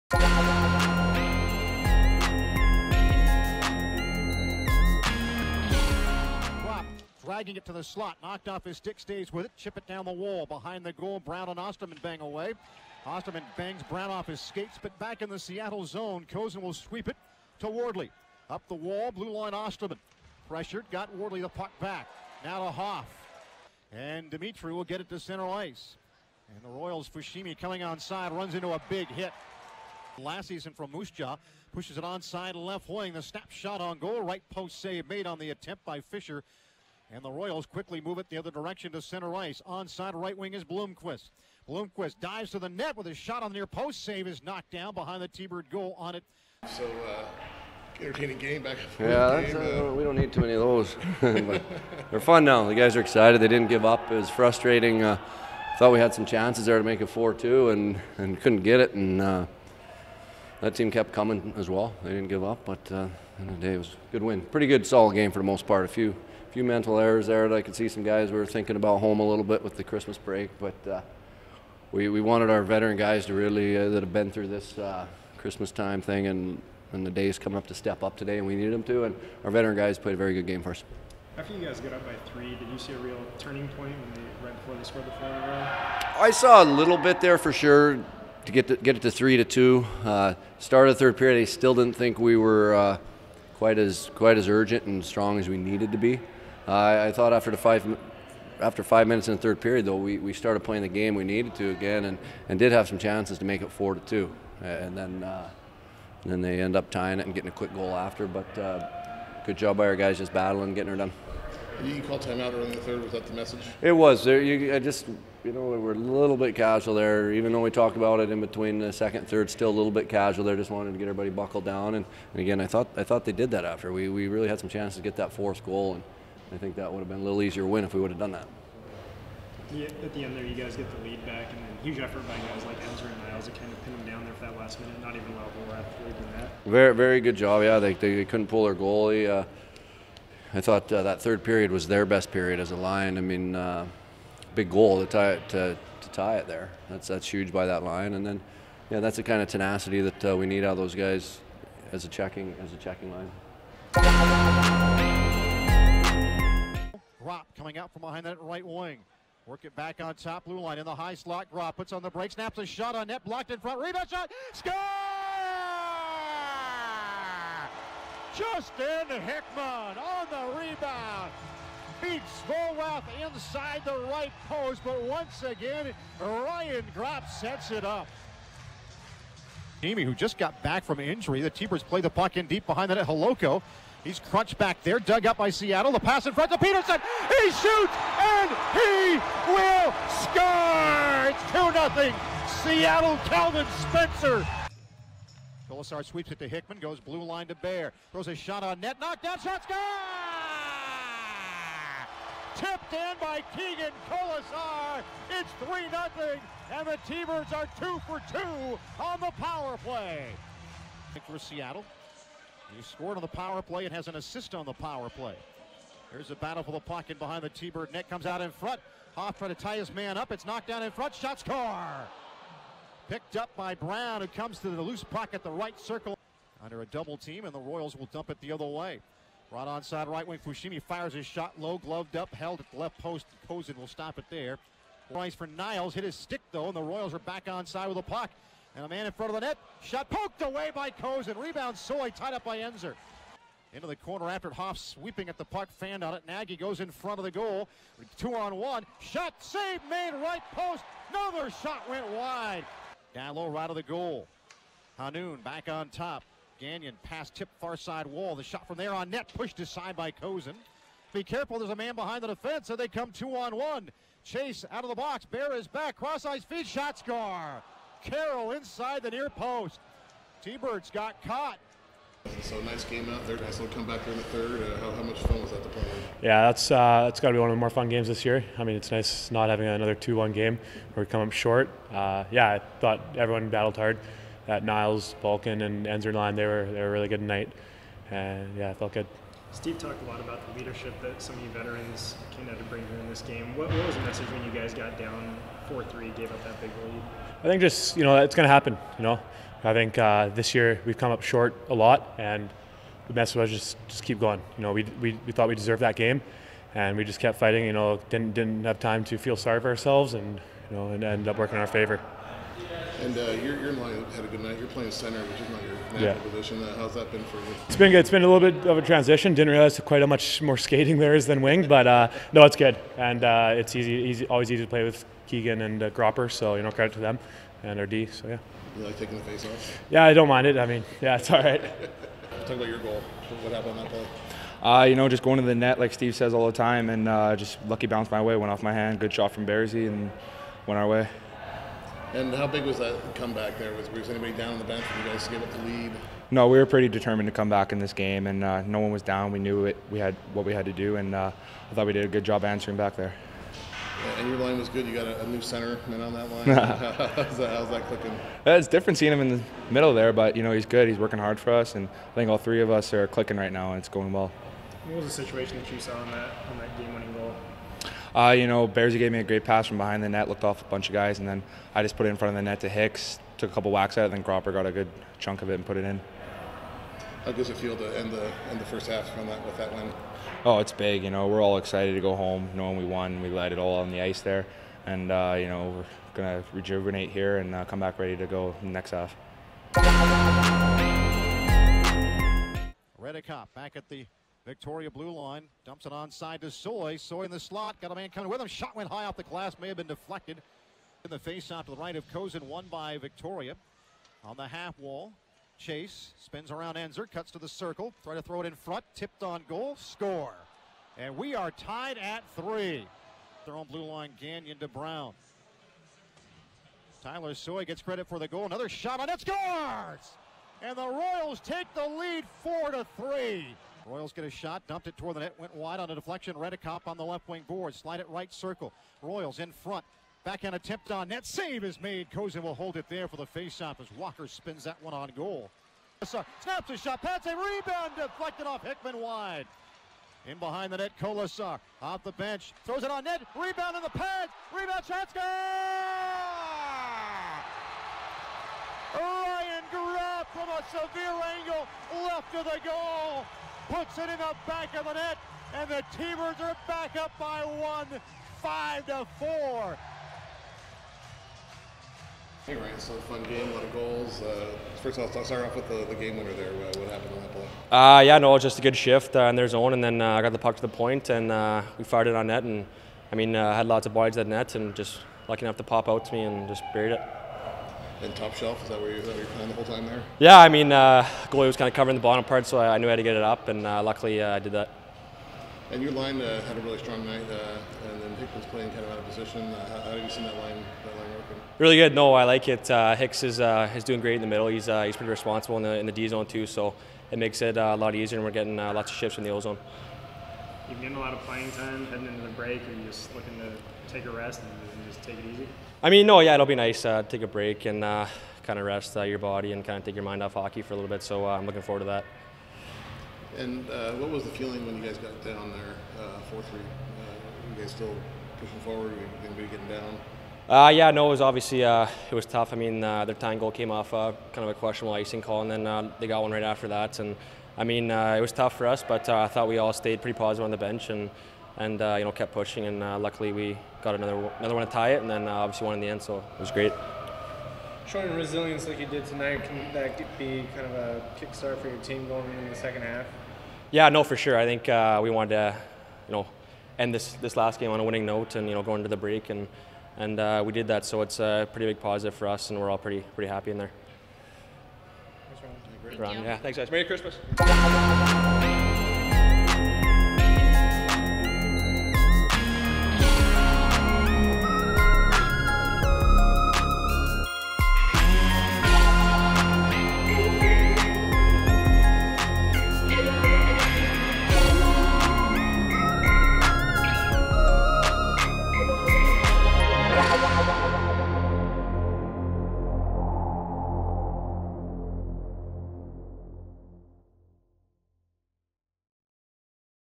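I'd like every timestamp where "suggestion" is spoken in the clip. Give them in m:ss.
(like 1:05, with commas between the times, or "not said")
not said.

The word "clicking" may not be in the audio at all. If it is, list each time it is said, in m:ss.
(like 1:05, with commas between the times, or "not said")
5:57, 6:03.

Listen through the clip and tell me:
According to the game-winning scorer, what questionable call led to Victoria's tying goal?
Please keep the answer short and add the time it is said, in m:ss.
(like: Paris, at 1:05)
Icing call, at 8:44.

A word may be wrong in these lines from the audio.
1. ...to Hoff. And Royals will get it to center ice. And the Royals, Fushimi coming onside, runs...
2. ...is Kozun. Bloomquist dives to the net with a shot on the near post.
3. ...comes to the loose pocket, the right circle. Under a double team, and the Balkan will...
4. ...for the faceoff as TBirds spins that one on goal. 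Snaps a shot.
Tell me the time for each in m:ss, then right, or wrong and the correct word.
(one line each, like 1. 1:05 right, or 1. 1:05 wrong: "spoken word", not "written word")
1. 0:22 wrong: "Dimitri", not "Royals"
2. 0:40 wrong: "Bloomquist", not "Kozun"
3. 3:44 wrong: "Royals", not "Balkan"
4. 7:13 wrong: "Walker", not "TBirds".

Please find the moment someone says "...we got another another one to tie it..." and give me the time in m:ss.
8:53.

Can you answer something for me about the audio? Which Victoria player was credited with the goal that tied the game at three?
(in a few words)
Tyler Soy.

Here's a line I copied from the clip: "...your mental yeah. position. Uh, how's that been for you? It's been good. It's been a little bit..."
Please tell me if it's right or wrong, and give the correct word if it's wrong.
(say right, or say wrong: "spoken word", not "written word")
wrong: "natural", not "mental".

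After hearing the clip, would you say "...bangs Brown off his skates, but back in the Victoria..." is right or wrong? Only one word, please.
wrong.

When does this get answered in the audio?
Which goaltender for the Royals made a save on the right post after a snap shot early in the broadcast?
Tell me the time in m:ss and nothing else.
0:36.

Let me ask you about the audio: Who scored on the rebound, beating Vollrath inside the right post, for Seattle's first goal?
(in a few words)
Justin Hickman.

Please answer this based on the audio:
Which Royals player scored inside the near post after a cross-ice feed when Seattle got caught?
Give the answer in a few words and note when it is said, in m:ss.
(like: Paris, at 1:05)
Carroll, at 4:28.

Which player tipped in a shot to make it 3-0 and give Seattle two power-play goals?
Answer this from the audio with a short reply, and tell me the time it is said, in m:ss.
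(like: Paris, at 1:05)
Keegan Kolesar, at 3:23.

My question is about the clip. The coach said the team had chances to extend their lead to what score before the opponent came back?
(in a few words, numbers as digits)
4-2.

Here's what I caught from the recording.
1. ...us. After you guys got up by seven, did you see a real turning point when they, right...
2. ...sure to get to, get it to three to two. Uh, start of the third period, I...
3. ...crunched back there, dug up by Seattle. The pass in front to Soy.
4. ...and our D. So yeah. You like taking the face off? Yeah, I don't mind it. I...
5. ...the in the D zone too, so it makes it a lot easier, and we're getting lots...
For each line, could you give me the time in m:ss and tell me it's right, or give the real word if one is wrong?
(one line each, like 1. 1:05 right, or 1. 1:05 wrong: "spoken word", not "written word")
1. 1:20 wrong: "three", not "seven"
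2. 1:27 right
3. 3:04 wrong: "Peterson", not "Soy"
4. 5:27 right
5. 8:15 right.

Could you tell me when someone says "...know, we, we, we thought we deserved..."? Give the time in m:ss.
5:04.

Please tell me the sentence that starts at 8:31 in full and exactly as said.
So uh, I'm looking forward to that.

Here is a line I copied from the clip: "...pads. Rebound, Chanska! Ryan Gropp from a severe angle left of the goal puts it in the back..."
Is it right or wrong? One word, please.
right.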